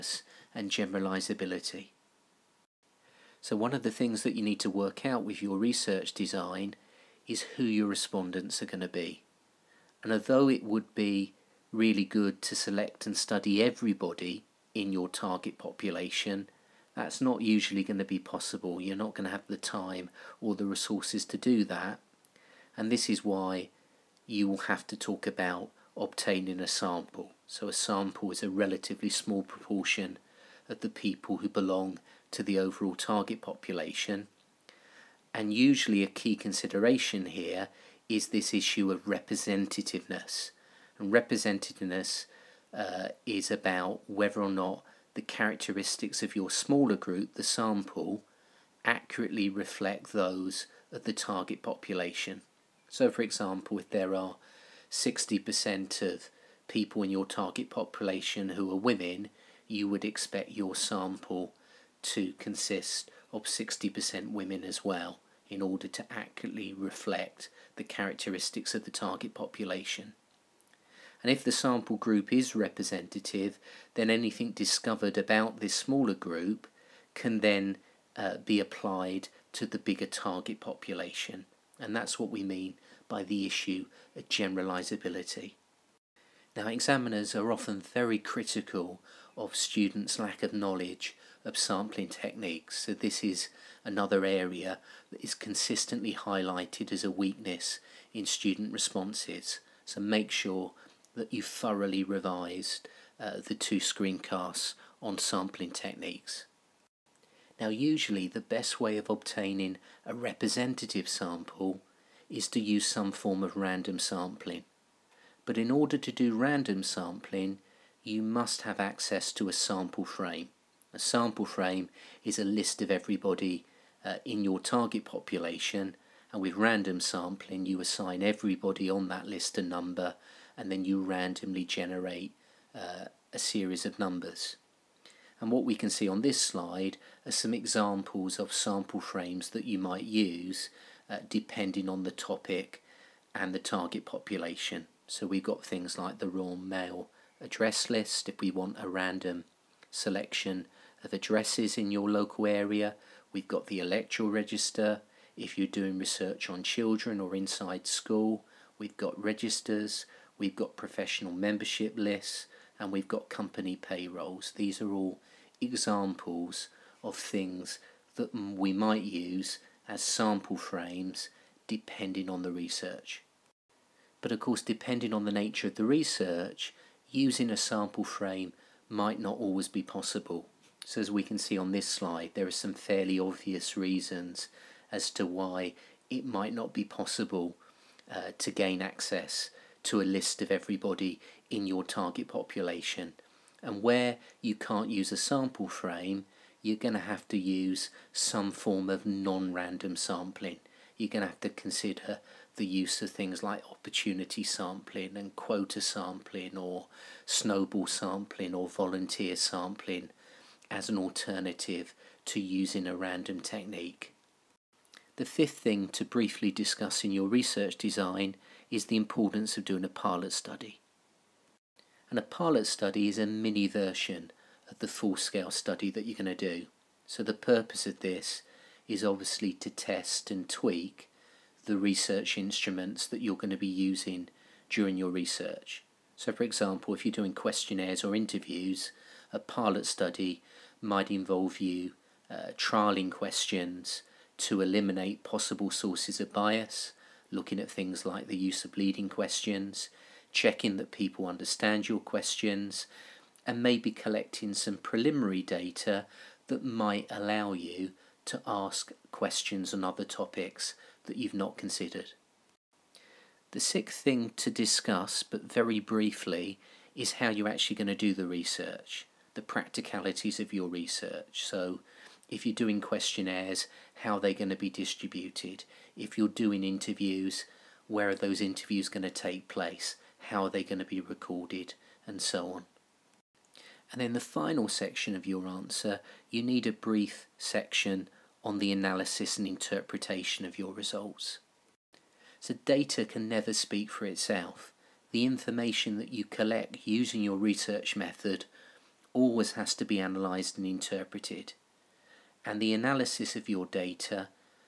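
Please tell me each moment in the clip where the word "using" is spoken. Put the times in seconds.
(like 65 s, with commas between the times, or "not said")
177 s, 212 s, 233 s, 296 s.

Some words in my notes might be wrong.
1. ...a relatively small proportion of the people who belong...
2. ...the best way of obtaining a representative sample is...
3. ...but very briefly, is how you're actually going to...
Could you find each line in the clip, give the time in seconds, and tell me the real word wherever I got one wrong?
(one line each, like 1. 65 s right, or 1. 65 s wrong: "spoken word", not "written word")
1. 28 s right
2. 108 s right
3. 265 s right.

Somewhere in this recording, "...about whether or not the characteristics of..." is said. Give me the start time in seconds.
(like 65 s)
43 s.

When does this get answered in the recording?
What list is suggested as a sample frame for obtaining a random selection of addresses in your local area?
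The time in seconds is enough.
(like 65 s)
146 s.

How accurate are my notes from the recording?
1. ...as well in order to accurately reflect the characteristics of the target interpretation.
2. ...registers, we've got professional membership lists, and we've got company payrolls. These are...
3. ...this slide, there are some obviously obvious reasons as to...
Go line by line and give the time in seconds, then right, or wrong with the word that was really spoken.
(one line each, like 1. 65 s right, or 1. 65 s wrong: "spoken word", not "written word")
1. 64 s wrong: "population", not "interpretation"
2. 159 s right
3. 181 s wrong: "fairly", not "obviously".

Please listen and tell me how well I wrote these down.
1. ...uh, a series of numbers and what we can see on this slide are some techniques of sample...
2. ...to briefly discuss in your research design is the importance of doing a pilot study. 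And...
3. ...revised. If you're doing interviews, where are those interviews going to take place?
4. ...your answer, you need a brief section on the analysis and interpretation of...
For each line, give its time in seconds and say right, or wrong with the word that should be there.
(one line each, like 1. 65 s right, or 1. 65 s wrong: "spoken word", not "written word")
1. 132 s wrong: "examples", not "techniques"
2. 215 s right
3. 274 s wrong: "distributed", not "revised"
4. 285 s right.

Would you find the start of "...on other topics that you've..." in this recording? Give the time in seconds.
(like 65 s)
259 s.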